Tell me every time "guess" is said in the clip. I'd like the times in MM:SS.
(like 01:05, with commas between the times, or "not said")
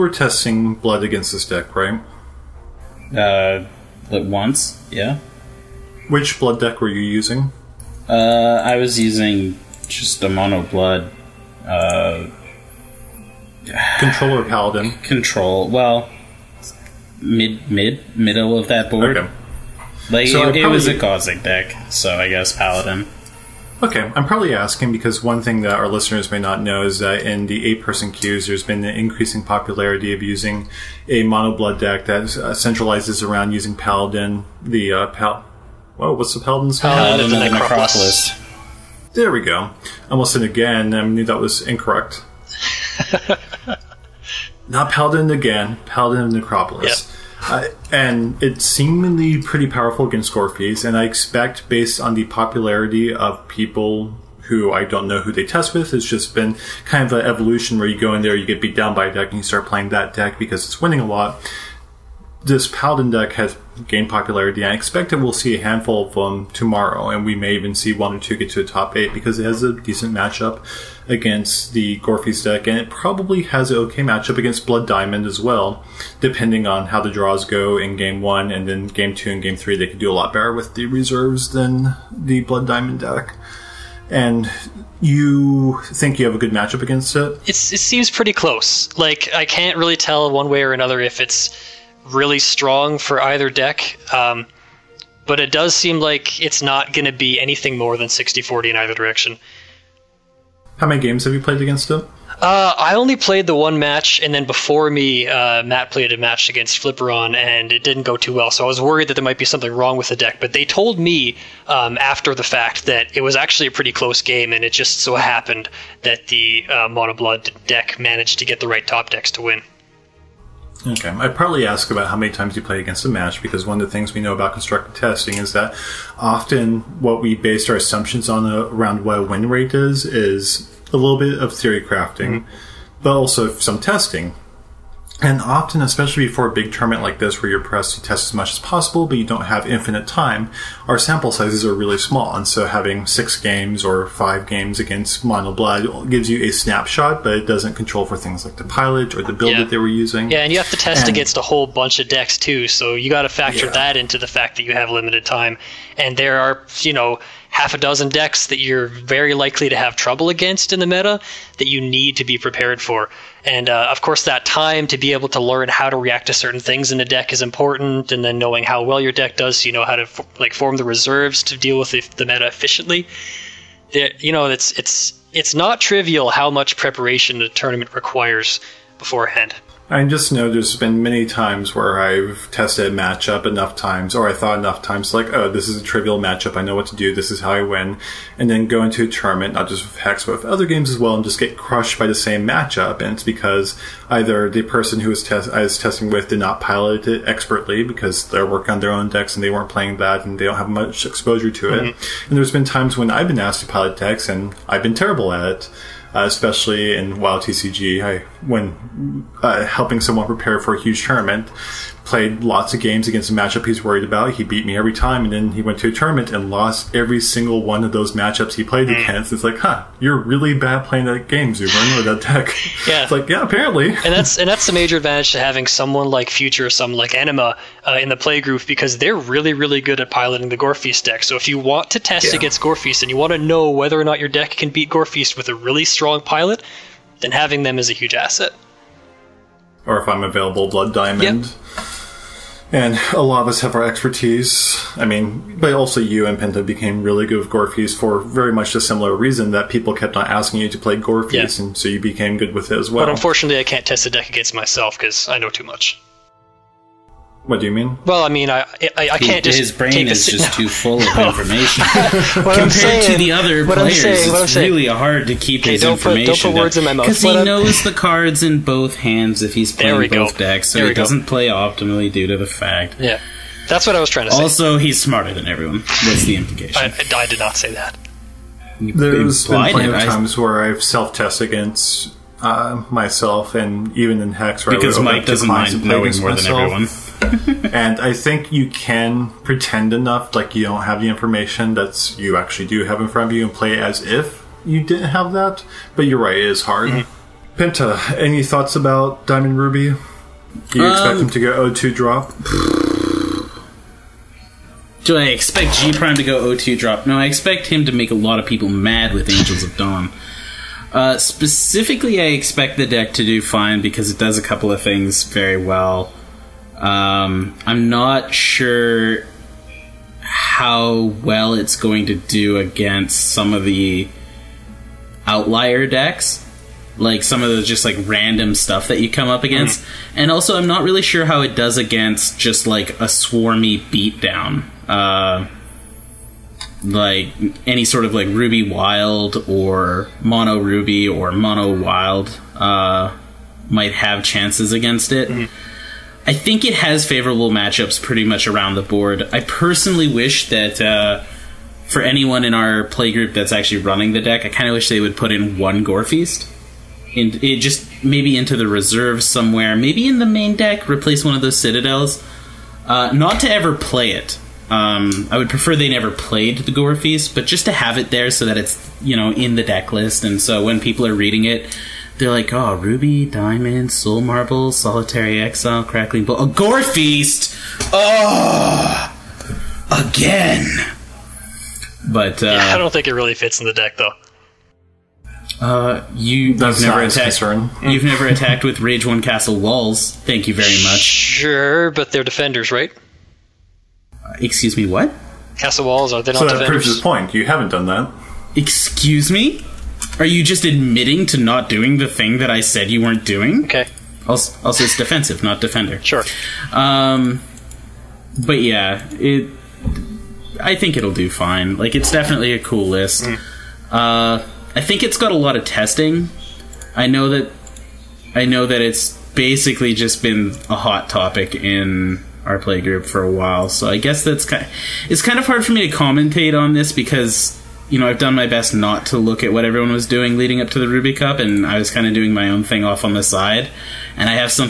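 00:22, 07:03.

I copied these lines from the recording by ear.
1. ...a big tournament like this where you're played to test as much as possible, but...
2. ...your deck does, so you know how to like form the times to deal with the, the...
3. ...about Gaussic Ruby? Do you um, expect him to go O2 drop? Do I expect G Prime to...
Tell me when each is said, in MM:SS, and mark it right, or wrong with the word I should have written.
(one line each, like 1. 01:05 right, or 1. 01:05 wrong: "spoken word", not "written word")
1. 02:16 wrong: "pressed", not "played"
2. 02:49 wrong: "reserves", not "times"
3. 04:58 wrong: "Diamond", not "Gaussic".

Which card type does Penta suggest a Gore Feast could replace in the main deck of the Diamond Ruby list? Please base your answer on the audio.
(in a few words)
citadels.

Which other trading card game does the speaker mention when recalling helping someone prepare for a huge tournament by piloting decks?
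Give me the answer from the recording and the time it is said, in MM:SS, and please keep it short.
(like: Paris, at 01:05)
WoW TCG, at 03:27.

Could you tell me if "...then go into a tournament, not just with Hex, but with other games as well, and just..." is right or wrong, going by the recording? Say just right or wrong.
right.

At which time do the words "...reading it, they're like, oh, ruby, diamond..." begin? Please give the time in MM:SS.
06:11.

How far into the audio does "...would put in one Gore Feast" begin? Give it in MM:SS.
05:55.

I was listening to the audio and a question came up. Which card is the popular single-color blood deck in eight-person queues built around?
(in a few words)
Paladin of Necropolis.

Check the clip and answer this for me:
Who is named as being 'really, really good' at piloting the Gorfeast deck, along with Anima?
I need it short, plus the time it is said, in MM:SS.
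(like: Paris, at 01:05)
Future, at 03:46.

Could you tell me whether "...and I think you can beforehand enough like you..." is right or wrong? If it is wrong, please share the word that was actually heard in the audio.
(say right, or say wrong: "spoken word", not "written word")
wrong: "pretend", not "beforehand".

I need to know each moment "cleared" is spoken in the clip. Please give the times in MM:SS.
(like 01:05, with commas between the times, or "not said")
not said.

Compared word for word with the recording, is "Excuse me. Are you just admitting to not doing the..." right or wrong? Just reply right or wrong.
right.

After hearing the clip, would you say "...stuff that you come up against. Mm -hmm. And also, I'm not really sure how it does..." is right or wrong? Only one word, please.
right.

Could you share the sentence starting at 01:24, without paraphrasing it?
And you think you have a good matchup against it?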